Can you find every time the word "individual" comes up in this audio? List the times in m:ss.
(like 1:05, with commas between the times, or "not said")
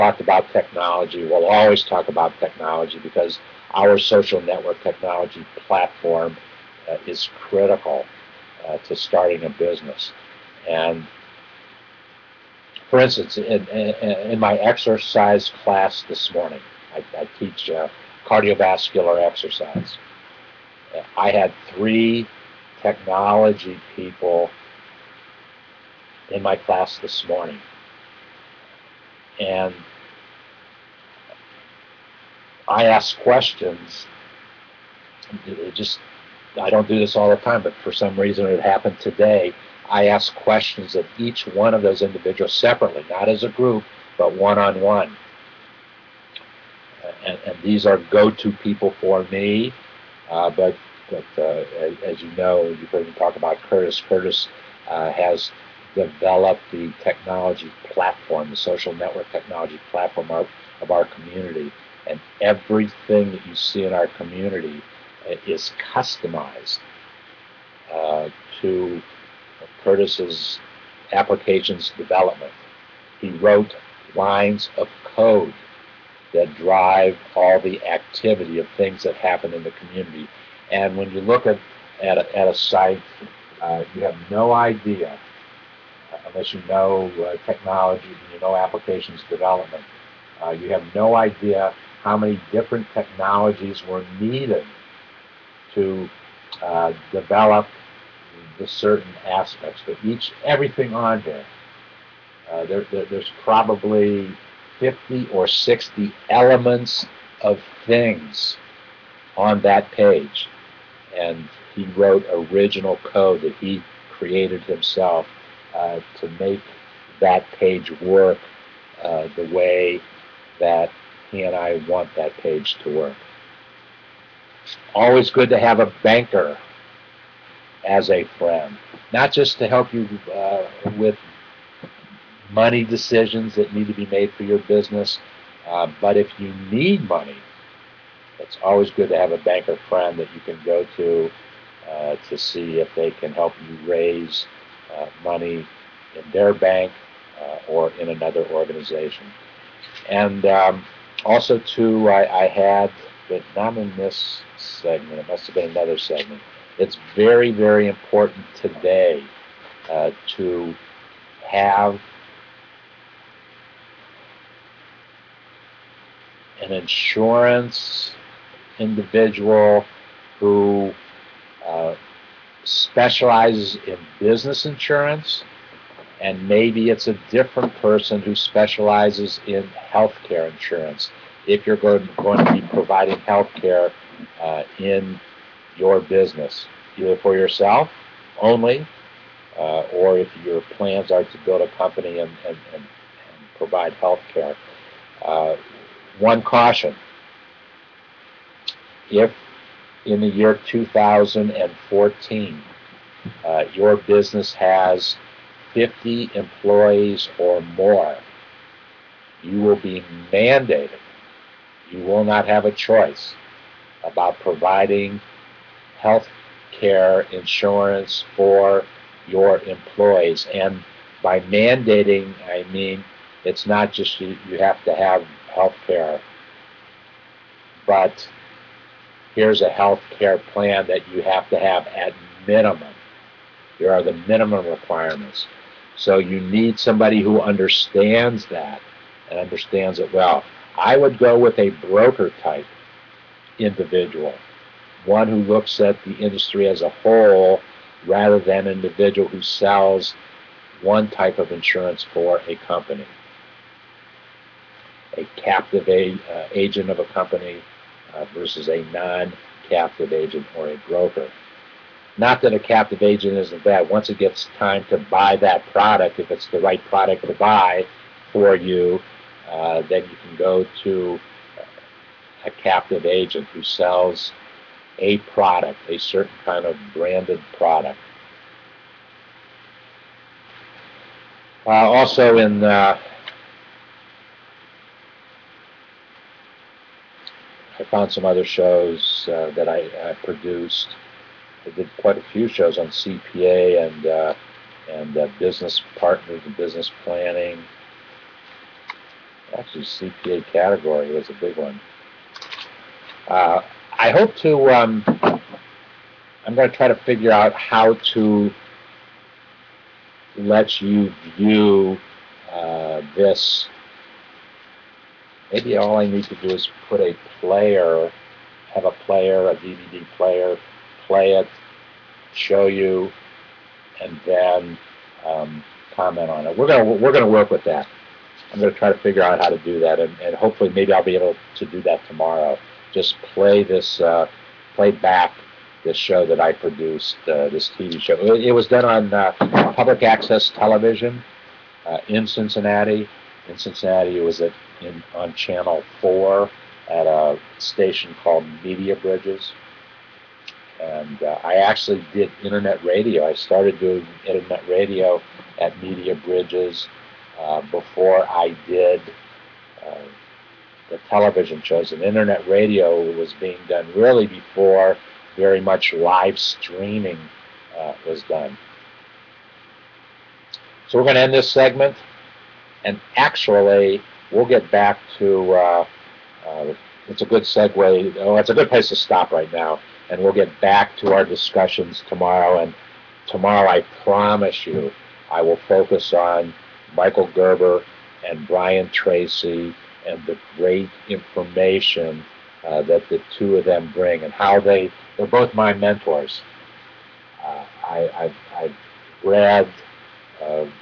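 0:42, 2:48, 4:03, 4:08.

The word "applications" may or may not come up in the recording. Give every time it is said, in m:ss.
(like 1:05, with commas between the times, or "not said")
1:11, 1:28.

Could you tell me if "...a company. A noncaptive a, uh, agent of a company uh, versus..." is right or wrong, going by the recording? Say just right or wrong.
wrong.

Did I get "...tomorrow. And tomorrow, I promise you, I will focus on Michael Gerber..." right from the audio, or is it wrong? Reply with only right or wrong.
right.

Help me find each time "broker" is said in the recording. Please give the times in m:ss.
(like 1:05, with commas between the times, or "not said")
4:01, 4:20.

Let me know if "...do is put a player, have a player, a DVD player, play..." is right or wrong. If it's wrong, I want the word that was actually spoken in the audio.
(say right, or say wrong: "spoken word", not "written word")
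right.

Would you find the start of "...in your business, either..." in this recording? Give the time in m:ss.
3:04.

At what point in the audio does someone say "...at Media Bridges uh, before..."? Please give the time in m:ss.
5:55.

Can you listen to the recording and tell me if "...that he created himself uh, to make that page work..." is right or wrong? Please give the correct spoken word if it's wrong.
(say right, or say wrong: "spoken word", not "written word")
right.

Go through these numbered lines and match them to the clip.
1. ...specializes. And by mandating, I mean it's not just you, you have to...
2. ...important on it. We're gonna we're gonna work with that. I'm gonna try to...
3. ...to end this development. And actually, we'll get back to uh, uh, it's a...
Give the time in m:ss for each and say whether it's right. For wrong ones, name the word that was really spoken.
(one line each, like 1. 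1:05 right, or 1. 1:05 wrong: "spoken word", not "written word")
1. 3:39 wrong: "employees", not "specializes"
2. 5:25 wrong: "comment", not "important"
3. 6:11 wrong: "segment", not "development".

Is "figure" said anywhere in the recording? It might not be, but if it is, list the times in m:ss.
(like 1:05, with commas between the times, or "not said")
5:06, 5:28.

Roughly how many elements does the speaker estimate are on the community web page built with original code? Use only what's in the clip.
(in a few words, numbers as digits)
50 or 60.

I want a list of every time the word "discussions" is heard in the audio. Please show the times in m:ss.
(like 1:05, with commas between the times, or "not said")
6:21.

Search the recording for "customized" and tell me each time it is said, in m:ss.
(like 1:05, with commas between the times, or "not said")
1:05.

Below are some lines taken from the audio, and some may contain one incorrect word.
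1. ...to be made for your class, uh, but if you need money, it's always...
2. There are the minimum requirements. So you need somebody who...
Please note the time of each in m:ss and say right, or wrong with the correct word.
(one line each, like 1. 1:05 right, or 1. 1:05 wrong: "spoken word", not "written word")
1. 2:13 wrong: "business", not "class"
2. 3:53 right.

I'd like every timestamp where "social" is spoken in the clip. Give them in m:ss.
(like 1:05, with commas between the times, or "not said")
0:03, 0:58.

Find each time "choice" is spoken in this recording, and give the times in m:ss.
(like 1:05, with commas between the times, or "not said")
3:32.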